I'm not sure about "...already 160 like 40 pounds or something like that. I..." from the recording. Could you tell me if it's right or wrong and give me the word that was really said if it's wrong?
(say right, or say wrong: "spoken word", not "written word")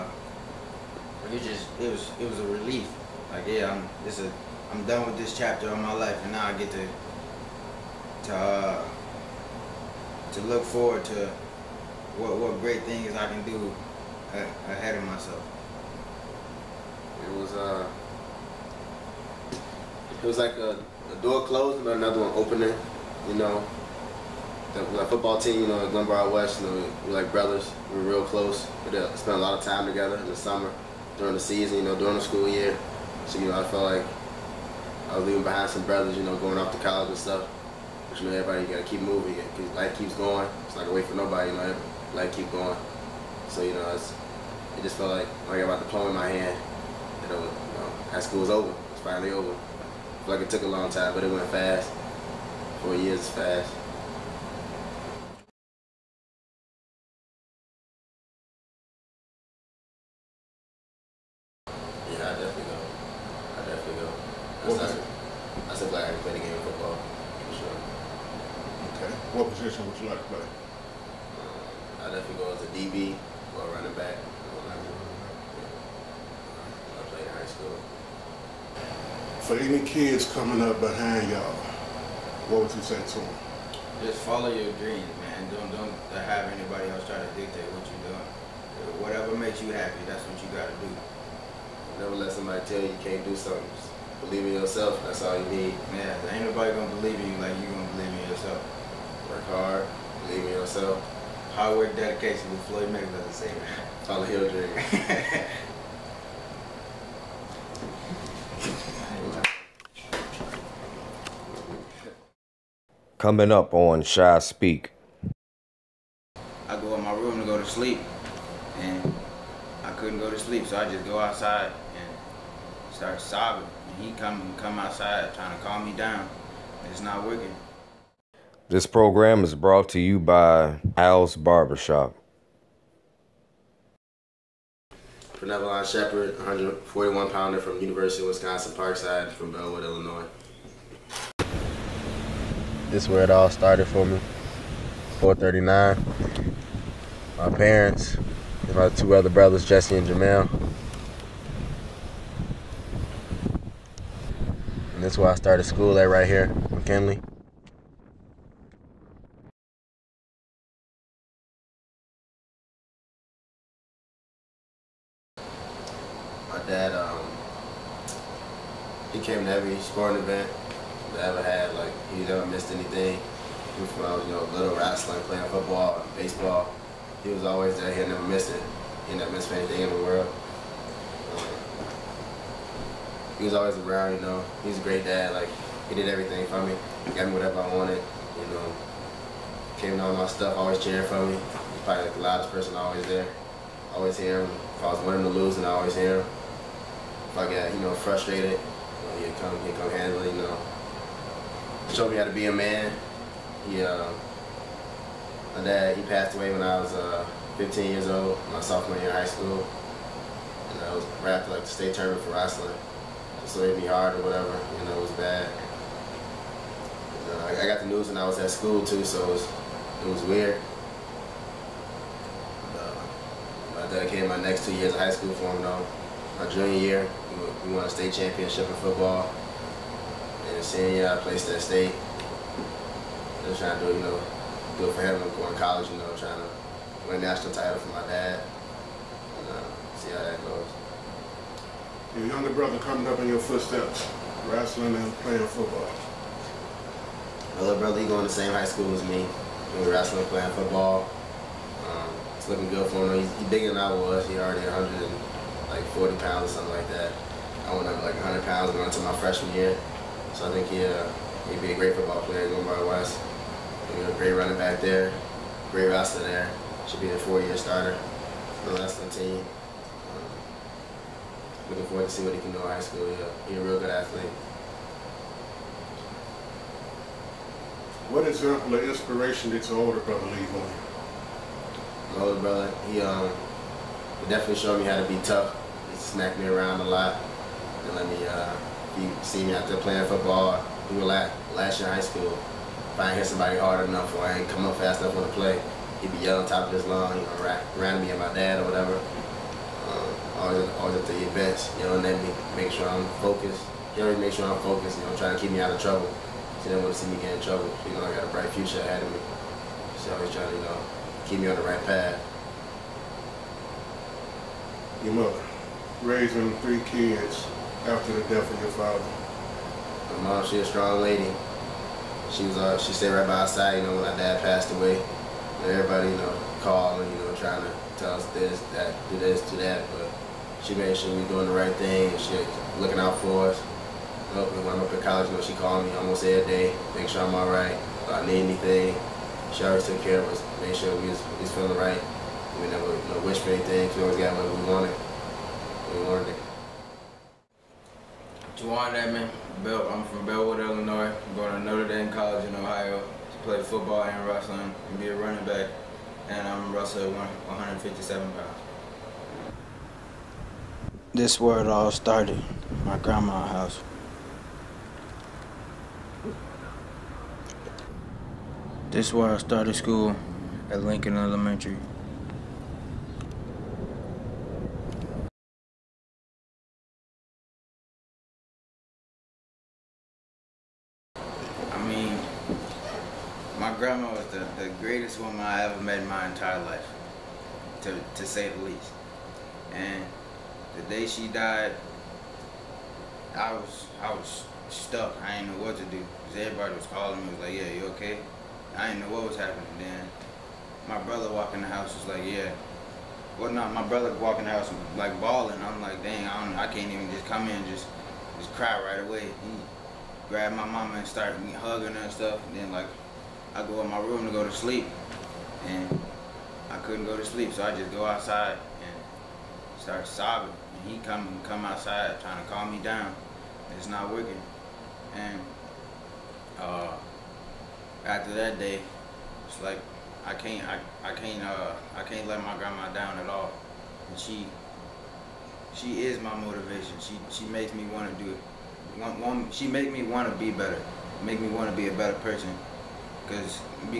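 wrong: "100", not "160".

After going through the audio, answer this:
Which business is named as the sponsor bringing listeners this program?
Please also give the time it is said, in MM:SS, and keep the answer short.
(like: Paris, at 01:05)
Al's Barbershop, at 02:10.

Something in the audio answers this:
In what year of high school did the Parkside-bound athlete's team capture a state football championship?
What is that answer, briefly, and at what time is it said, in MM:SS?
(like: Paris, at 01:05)
Junior year, at 03:46.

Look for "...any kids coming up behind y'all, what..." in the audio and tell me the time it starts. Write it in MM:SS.
01:19.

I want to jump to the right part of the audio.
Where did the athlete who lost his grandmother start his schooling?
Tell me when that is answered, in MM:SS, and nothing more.
06:10.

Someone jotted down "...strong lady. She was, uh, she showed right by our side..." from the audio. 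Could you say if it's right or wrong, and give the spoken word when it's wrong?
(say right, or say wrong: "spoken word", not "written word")
wrong: "stayed", not "showed".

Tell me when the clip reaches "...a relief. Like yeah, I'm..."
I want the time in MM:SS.
00:02.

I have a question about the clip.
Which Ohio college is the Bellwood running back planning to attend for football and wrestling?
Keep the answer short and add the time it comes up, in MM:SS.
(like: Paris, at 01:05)
Notre Dame College, at 05:51.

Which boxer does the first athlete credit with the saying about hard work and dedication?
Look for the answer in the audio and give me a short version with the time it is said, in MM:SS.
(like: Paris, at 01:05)
Floyd Mayweather, at 01:42.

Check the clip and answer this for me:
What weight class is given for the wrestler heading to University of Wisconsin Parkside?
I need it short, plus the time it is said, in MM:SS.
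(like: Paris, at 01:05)
141 pounds, at 02:16.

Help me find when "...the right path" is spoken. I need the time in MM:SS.
05:11.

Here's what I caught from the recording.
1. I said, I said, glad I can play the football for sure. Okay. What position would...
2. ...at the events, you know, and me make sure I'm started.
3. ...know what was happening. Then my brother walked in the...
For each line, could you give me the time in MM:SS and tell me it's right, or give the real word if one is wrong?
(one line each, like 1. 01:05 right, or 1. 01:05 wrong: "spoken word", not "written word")
1. 01:04 right
2. 05:00 wrong: "focused", not "started"
3. 06:38 right.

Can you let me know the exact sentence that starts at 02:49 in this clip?
came to every sporting event I ever had.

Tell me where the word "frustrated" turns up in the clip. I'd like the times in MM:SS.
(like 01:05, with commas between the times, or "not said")
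03:17.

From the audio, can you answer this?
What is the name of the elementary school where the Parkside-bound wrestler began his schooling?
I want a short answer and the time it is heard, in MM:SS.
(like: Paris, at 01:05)
McKinley, at 02:36.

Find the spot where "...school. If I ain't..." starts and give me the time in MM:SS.
04:51.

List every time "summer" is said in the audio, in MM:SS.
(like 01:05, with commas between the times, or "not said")
00:30.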